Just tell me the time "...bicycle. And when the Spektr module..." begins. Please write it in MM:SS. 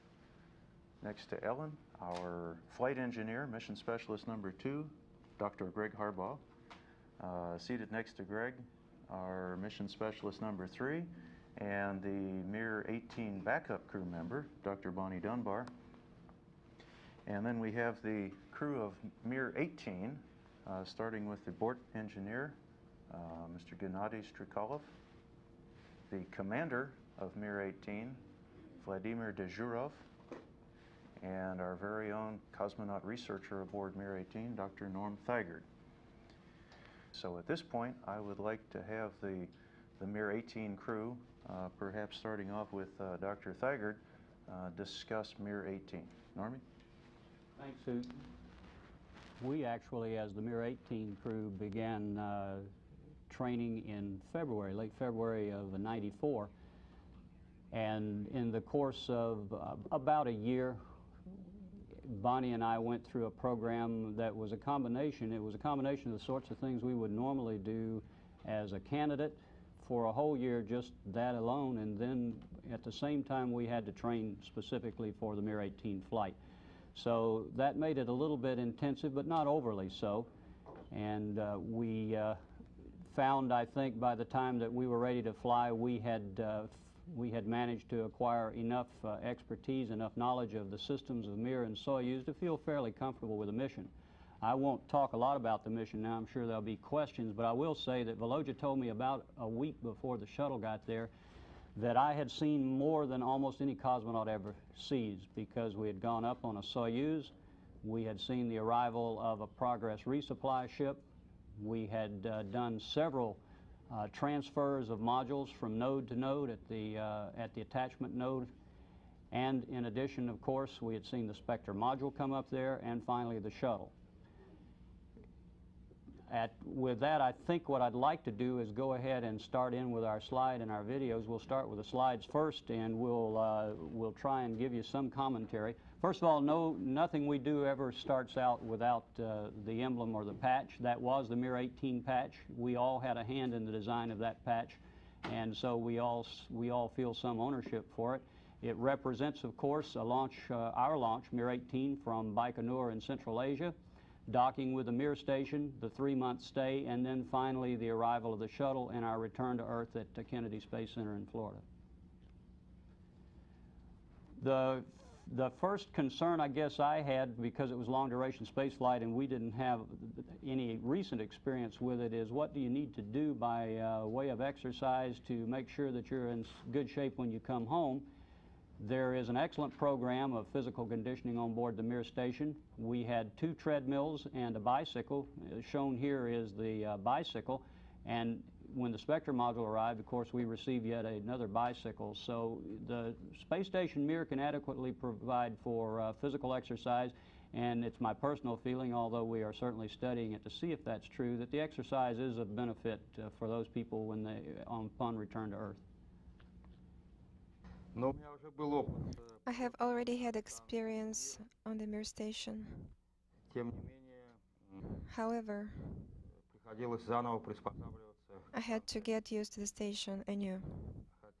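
03:06.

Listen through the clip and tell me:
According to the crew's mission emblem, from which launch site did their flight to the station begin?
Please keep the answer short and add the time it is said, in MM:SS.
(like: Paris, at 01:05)
Baikonur, at 02:32.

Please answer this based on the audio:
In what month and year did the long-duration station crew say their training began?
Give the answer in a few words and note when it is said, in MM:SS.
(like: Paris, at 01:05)
February 1994, at 00:54.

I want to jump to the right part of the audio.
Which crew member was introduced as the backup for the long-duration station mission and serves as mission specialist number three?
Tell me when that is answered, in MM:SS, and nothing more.
00:14.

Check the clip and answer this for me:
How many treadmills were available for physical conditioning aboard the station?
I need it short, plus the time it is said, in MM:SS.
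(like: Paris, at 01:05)
2, at 03:03.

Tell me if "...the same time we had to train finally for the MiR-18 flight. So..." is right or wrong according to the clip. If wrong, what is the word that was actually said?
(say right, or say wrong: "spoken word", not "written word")
wrong: "specifically", not "finally".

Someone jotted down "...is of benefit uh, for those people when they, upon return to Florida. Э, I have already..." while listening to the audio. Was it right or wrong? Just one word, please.
wrong.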